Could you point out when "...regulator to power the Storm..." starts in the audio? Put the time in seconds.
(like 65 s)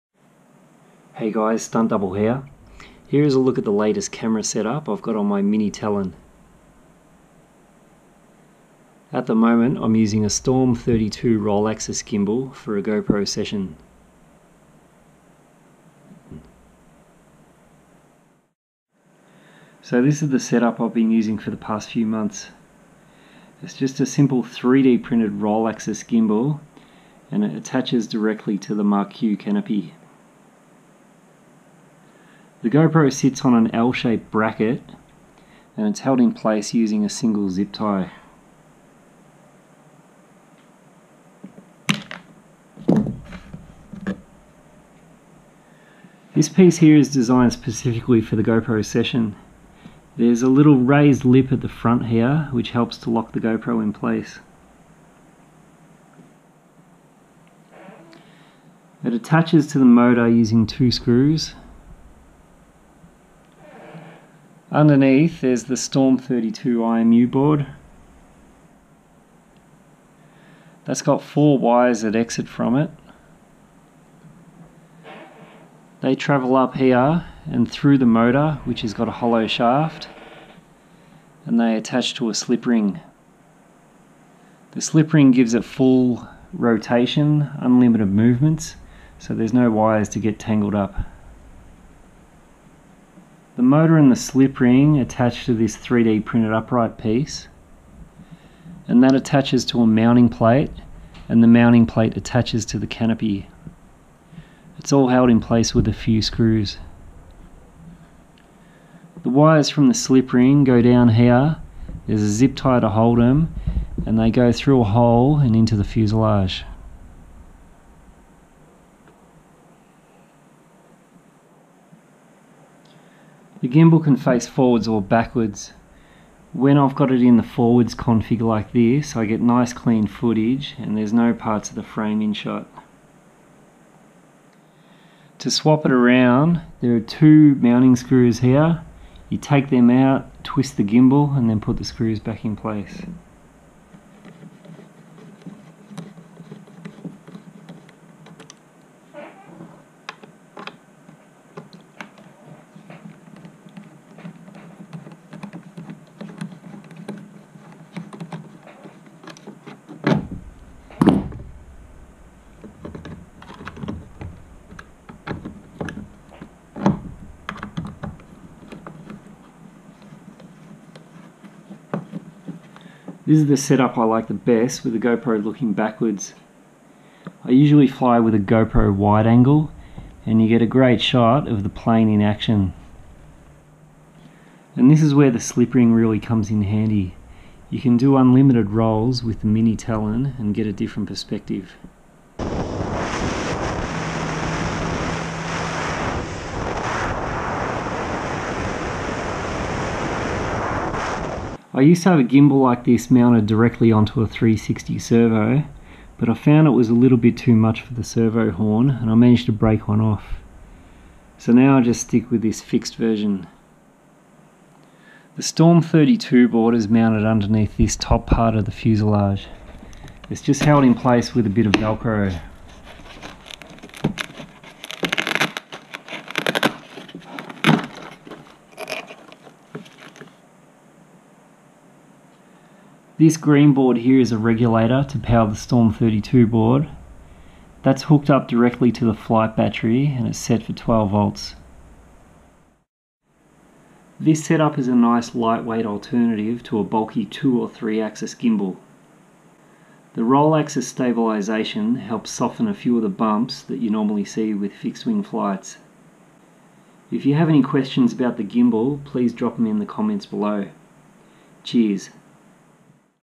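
234 s.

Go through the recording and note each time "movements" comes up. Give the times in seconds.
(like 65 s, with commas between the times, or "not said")
88 s.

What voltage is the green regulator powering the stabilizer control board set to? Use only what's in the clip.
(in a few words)
12 volts.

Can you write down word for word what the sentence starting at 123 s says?
gimbal can face forwards or backwards.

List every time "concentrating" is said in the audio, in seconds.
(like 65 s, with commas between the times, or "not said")
not said.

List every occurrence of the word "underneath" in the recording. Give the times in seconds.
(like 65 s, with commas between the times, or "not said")
64 s, 217 s.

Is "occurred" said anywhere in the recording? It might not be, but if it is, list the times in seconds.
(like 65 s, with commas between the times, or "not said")
not said.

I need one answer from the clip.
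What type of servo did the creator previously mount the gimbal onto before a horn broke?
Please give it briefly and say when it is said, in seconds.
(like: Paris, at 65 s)
360 servo, at 204 s.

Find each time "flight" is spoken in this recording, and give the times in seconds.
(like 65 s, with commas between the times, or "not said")
239 s, 255 s.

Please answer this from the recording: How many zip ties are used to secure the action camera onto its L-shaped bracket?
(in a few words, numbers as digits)
1.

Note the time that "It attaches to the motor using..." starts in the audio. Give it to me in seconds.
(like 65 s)
59 s.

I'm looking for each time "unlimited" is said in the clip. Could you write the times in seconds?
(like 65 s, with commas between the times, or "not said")
87 s, 188 s.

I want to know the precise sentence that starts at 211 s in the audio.
So now I just stick with this fixed version.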